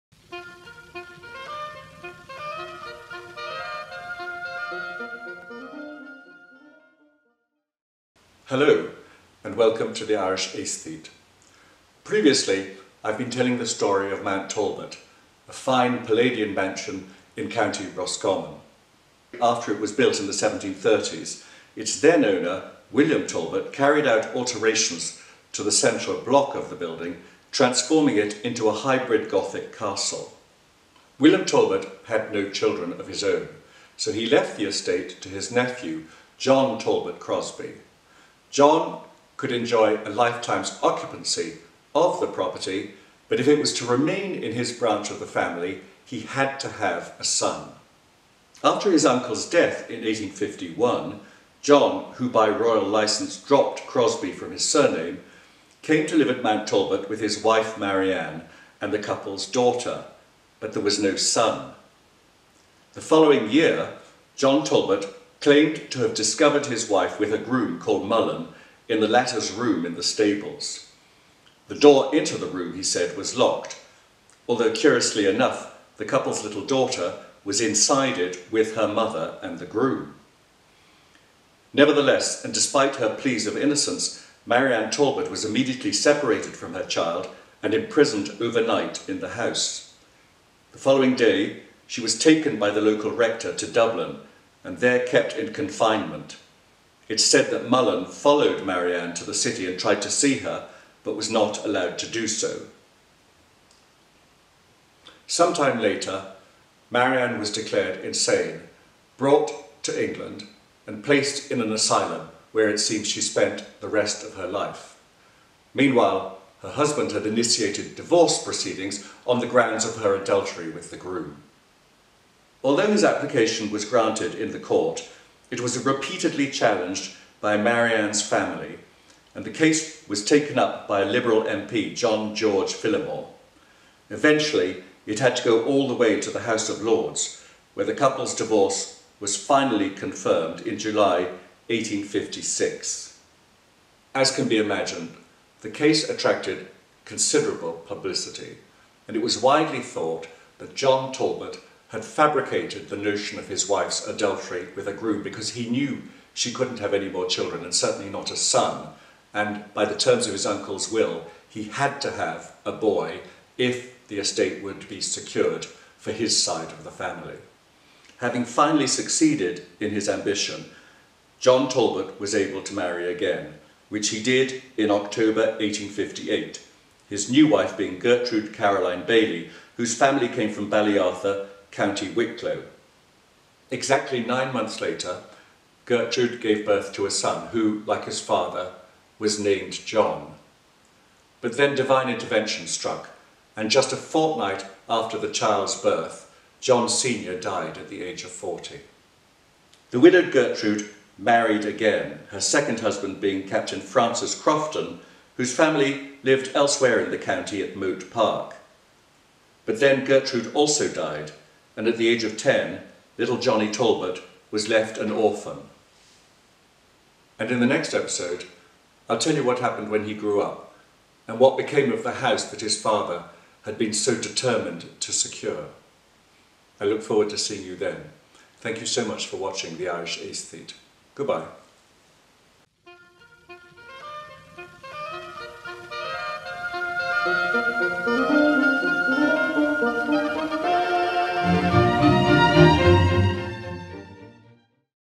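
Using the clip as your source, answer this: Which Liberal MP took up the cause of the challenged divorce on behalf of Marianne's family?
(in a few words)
John George Phillimore.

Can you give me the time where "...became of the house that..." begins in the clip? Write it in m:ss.
3:41.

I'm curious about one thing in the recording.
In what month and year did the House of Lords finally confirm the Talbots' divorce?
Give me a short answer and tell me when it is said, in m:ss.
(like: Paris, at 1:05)
July 1856, at 2:20.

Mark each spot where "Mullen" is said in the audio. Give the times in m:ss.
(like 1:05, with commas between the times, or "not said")
1:08, 1:37.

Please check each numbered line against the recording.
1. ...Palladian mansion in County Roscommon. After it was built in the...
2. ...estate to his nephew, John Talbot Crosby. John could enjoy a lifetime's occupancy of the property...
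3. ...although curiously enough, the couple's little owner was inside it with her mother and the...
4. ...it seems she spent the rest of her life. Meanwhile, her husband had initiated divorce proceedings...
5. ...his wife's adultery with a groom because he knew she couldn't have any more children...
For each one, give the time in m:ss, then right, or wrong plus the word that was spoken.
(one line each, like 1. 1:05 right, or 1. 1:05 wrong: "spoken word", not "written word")
1. 0:16 right
2. 0:34 right
3. 1:14 wrong: "daughter", not "owner"
4. 1:52 right
5. 2:33 right.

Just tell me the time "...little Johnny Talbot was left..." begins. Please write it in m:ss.
3:33.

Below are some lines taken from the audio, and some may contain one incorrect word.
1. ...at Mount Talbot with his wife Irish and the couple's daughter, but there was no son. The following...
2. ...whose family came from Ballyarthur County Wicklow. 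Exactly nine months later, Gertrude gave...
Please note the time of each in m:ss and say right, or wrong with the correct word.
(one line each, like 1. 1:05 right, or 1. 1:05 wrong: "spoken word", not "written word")
1. 0:56 wrong: "Marianne", not "Irish"
2. 2:59 right.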